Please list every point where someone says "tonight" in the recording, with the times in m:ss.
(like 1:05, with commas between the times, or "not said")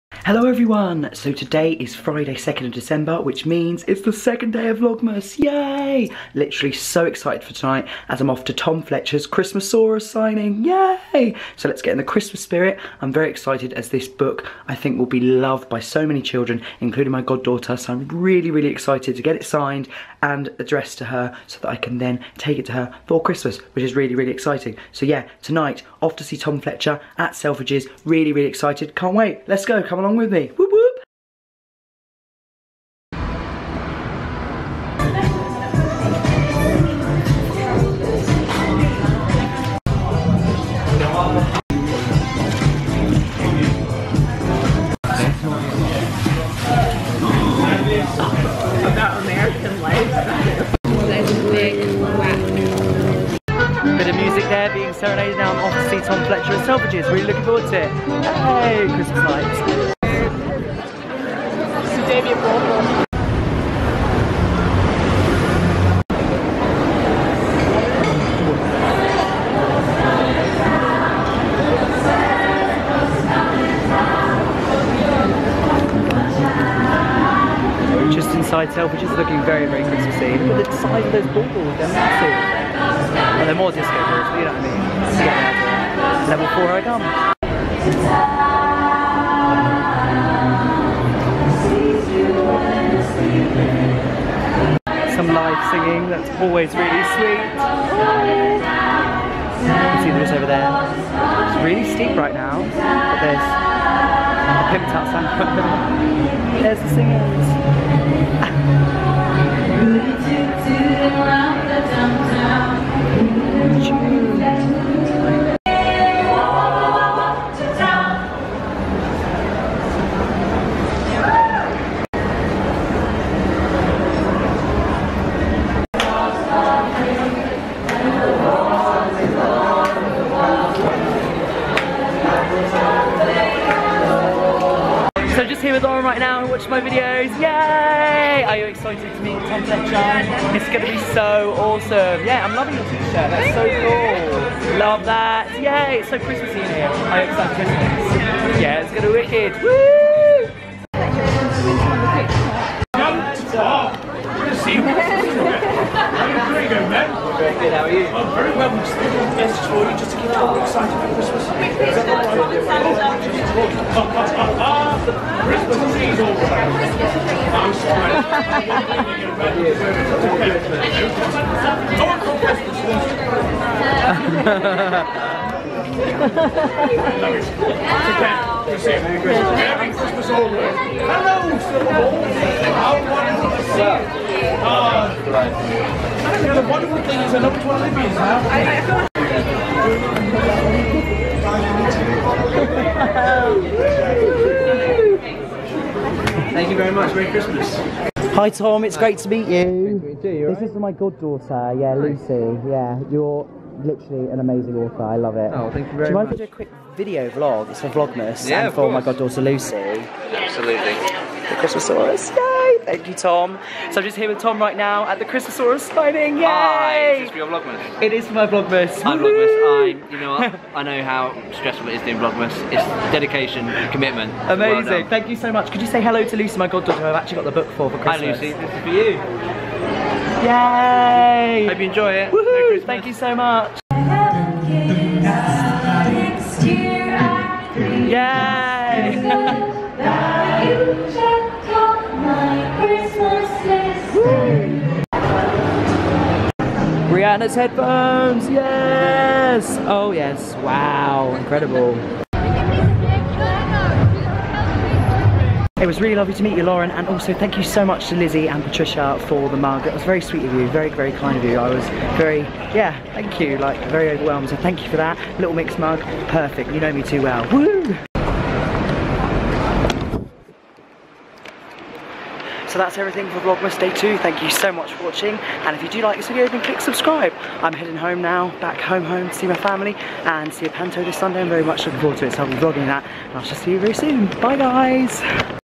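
0:07, 0:25.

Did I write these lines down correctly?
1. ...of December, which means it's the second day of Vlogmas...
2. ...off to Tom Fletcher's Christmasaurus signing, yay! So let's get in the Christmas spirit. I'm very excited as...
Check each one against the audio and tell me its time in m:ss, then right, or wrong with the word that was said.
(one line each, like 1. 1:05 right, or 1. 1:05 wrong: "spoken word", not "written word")
1. 0:02 right
2. 0:08 right.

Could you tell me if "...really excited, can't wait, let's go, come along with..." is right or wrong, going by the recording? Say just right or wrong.
right.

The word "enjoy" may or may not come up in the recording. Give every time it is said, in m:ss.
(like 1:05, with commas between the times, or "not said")
3:51.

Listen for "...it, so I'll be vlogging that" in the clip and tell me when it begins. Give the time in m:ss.
4:42.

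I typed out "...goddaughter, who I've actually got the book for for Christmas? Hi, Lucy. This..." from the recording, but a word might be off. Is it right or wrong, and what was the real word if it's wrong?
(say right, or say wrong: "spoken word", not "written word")
right.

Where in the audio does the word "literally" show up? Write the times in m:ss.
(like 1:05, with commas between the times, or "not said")
0:06, 3:23.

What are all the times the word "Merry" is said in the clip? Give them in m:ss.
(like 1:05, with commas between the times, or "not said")
3:17, 3:52.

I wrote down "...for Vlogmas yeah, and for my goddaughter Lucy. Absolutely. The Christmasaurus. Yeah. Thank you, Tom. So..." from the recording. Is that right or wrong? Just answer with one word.
right.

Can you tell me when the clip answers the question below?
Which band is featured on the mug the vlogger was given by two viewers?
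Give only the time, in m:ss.
4:25.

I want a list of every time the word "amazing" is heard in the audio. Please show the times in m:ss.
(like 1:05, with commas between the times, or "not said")
3:24, 3:44.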